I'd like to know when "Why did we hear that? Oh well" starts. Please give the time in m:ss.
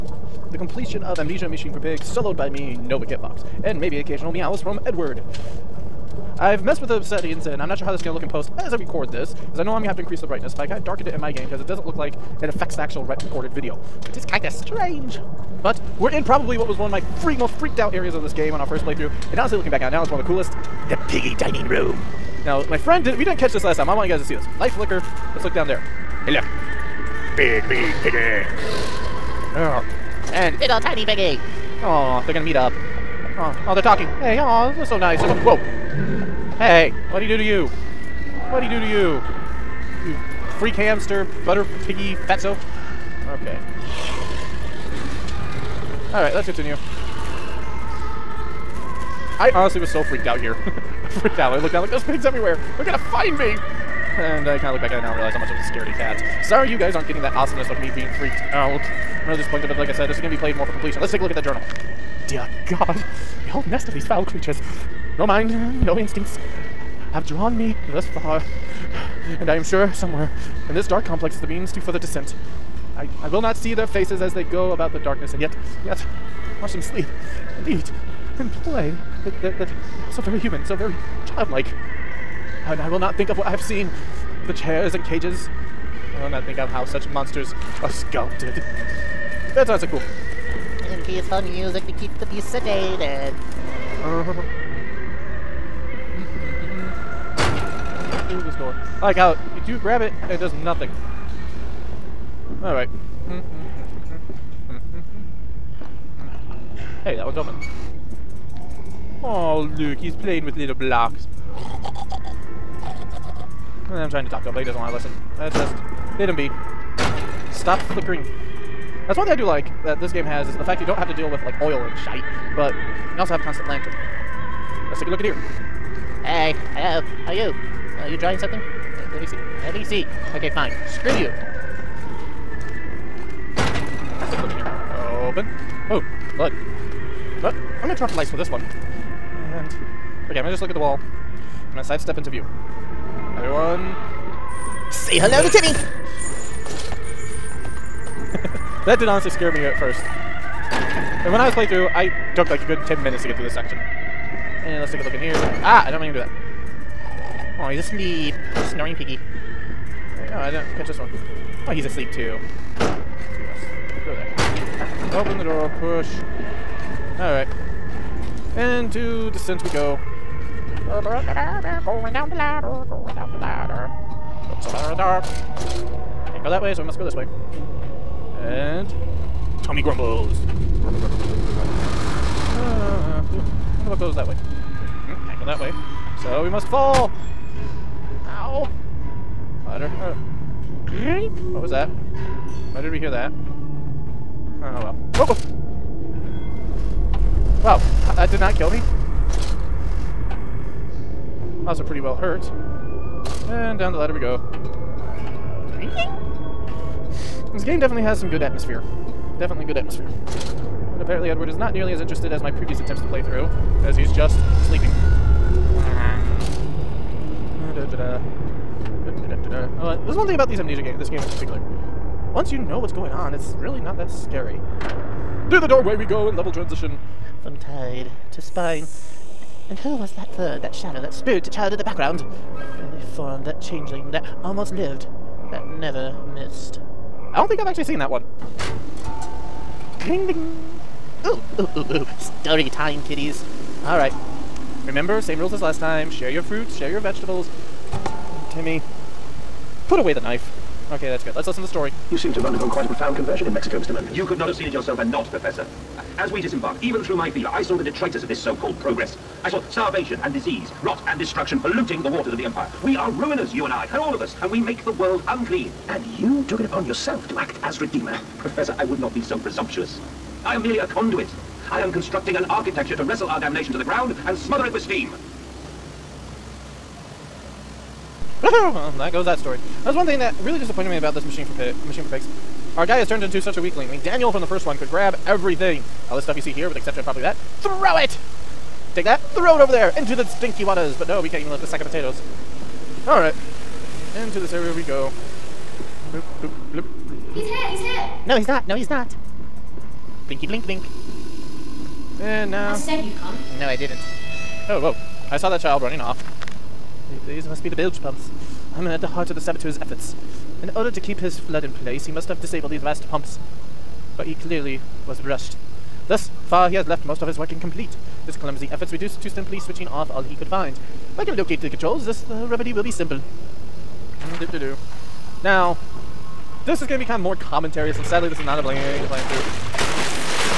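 3:12.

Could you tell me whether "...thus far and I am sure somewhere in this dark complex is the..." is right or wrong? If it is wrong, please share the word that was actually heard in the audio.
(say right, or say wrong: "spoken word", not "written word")
right.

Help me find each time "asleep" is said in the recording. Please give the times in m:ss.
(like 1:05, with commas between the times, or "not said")
2:37, 2:41.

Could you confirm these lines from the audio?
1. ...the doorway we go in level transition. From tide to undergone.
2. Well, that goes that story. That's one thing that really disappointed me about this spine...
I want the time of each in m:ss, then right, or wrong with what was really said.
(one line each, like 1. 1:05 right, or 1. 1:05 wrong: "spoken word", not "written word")
1. 3:45 wrong: "spine", not "undergone"
2. 4:38 wrong: "machine", not "spine".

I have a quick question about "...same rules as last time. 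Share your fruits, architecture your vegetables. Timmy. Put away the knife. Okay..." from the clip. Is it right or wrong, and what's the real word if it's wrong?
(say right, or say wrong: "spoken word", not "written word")
wrong: "share", not "architecture".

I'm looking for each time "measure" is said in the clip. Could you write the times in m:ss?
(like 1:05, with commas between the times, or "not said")
not said.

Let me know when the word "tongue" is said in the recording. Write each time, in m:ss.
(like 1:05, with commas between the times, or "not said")
not said.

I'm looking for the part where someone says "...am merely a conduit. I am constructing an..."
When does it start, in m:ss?
4:30.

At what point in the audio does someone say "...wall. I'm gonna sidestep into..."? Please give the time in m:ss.
2:20.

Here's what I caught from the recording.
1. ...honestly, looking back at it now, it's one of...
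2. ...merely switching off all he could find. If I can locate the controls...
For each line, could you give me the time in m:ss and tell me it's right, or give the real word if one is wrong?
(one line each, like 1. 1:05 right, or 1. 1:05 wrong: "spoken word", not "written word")
1. 0:19 right
2. 5:19 wrong: "simply", not "merely".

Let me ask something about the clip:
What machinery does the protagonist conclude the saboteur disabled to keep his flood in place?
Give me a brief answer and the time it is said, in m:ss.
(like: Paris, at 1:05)
bilge pumps, at 5:07.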